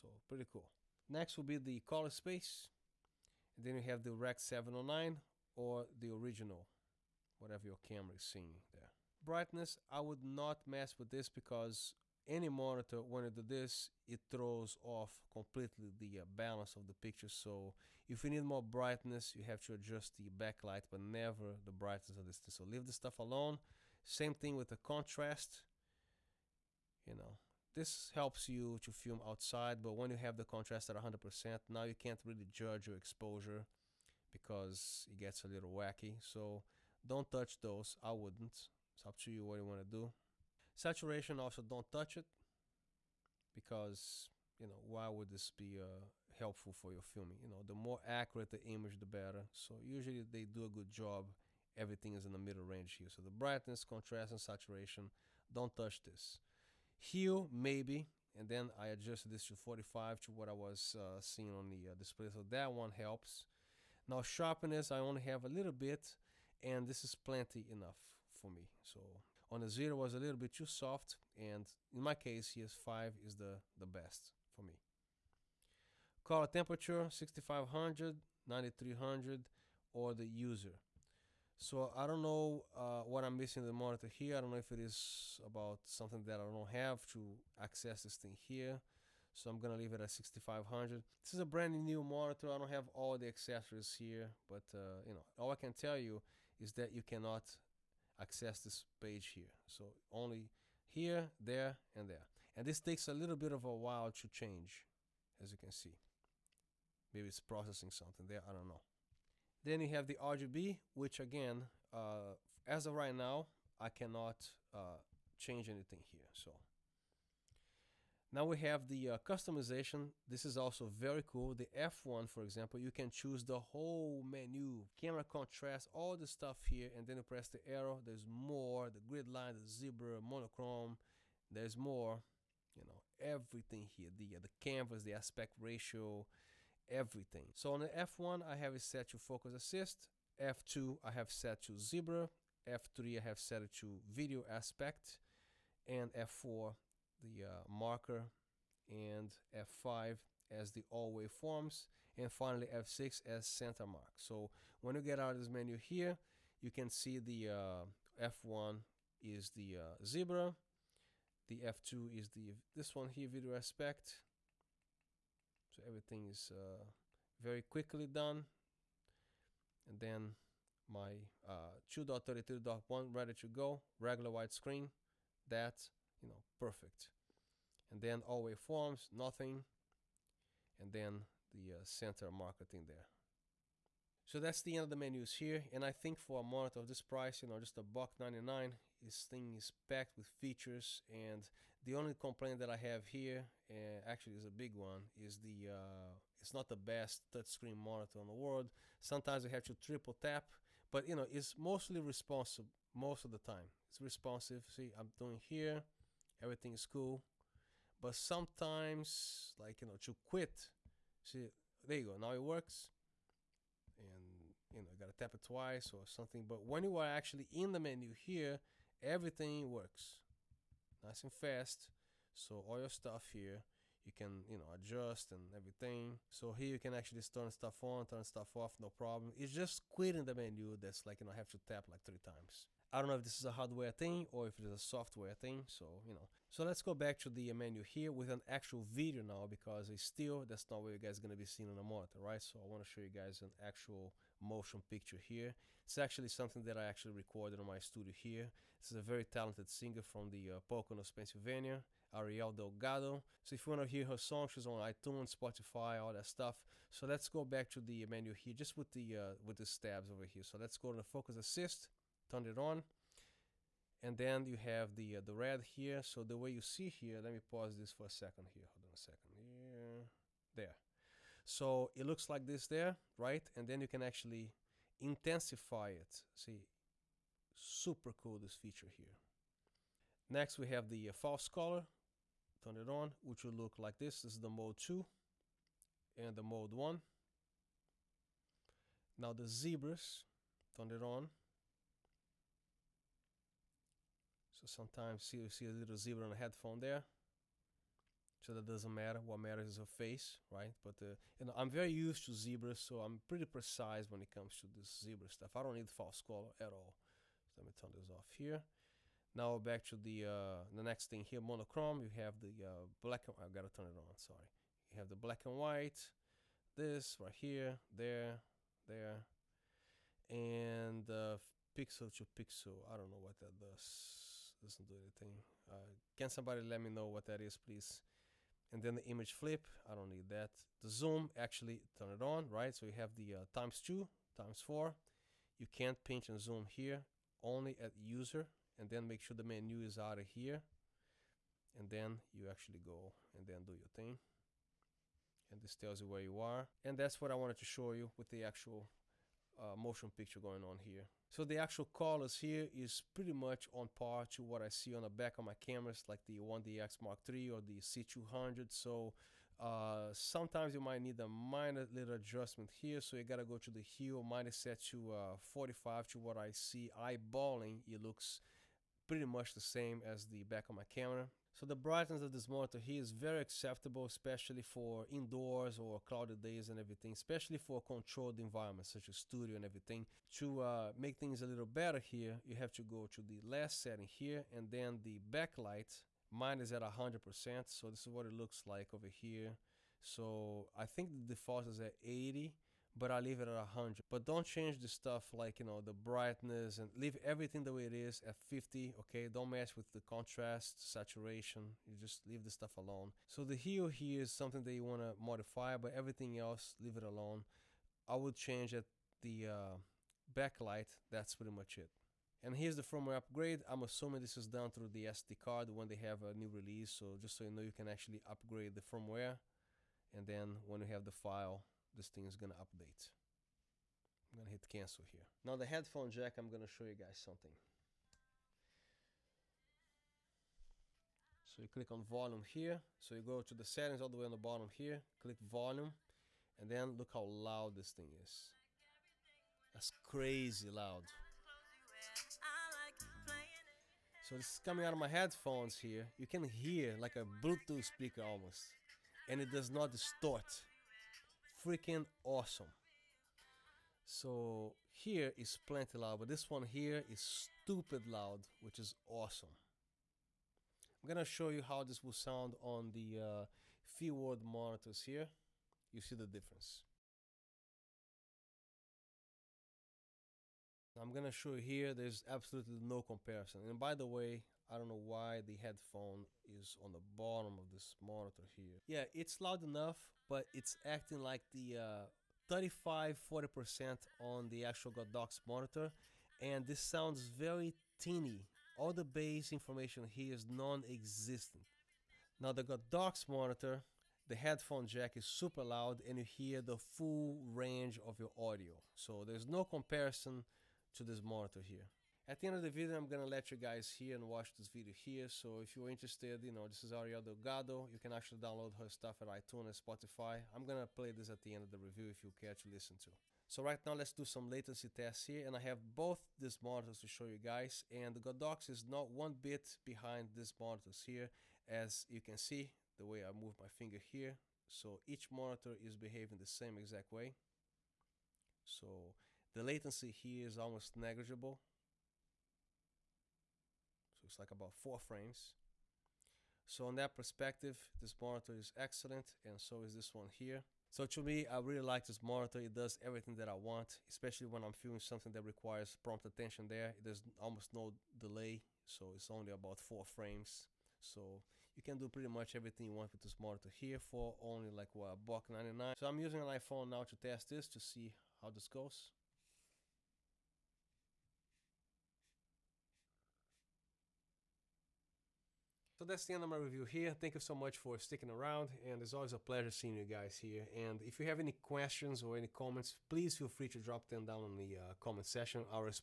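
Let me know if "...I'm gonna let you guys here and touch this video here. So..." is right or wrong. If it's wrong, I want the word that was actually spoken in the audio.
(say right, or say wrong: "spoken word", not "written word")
wrong: "watch", not "touch".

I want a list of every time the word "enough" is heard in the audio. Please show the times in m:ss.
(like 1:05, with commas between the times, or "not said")
1:07, 7:59.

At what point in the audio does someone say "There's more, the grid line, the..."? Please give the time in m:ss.
2:08.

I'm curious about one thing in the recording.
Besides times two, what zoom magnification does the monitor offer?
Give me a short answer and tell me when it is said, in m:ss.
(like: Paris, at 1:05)
Times four, at 5:34.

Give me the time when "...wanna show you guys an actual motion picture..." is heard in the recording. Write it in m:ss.
4:02.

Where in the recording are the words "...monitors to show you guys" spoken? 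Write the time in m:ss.
8:36.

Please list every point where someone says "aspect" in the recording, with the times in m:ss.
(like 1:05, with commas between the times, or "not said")
2:15, 2:24, 2:43.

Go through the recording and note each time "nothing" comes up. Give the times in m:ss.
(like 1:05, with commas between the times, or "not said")
2:59.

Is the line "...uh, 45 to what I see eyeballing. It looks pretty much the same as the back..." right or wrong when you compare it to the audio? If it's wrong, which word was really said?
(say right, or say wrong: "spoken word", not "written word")
right.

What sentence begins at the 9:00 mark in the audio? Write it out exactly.
So to me, I really like this monitor.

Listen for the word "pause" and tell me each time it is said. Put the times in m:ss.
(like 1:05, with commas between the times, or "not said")
4:27.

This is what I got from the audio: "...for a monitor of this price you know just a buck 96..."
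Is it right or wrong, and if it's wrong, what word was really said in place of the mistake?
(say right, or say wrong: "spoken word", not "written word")
wrong: "99", not "96".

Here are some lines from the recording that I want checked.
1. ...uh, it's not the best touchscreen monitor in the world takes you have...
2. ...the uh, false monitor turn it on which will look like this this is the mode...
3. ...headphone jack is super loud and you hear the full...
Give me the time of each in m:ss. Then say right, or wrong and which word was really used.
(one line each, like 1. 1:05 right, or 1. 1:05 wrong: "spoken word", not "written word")
1. 3:15 wrong: "sometimes", not "takes"
2. 4:40 wrong: "color", not "monitor"
3. 8:14 right.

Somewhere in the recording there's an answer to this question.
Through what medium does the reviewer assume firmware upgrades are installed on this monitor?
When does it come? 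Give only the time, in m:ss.
6:55.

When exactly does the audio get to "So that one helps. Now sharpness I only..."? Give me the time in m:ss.
1:02.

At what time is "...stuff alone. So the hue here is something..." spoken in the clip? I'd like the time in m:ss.
6:42.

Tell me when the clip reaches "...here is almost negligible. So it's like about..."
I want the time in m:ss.
8:50.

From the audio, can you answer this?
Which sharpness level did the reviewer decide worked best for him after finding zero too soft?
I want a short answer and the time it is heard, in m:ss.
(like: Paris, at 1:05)
5, at 1:12.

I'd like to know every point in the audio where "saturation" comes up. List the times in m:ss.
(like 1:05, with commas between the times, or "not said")
0:40, 0:54, 6:40.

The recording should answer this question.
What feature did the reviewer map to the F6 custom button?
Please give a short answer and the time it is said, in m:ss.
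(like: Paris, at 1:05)
Center mark, at 2:33.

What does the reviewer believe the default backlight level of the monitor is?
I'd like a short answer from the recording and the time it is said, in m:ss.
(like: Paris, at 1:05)
80, at 6:32.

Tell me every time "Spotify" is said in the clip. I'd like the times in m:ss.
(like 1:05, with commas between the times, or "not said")
4:15, 8:29.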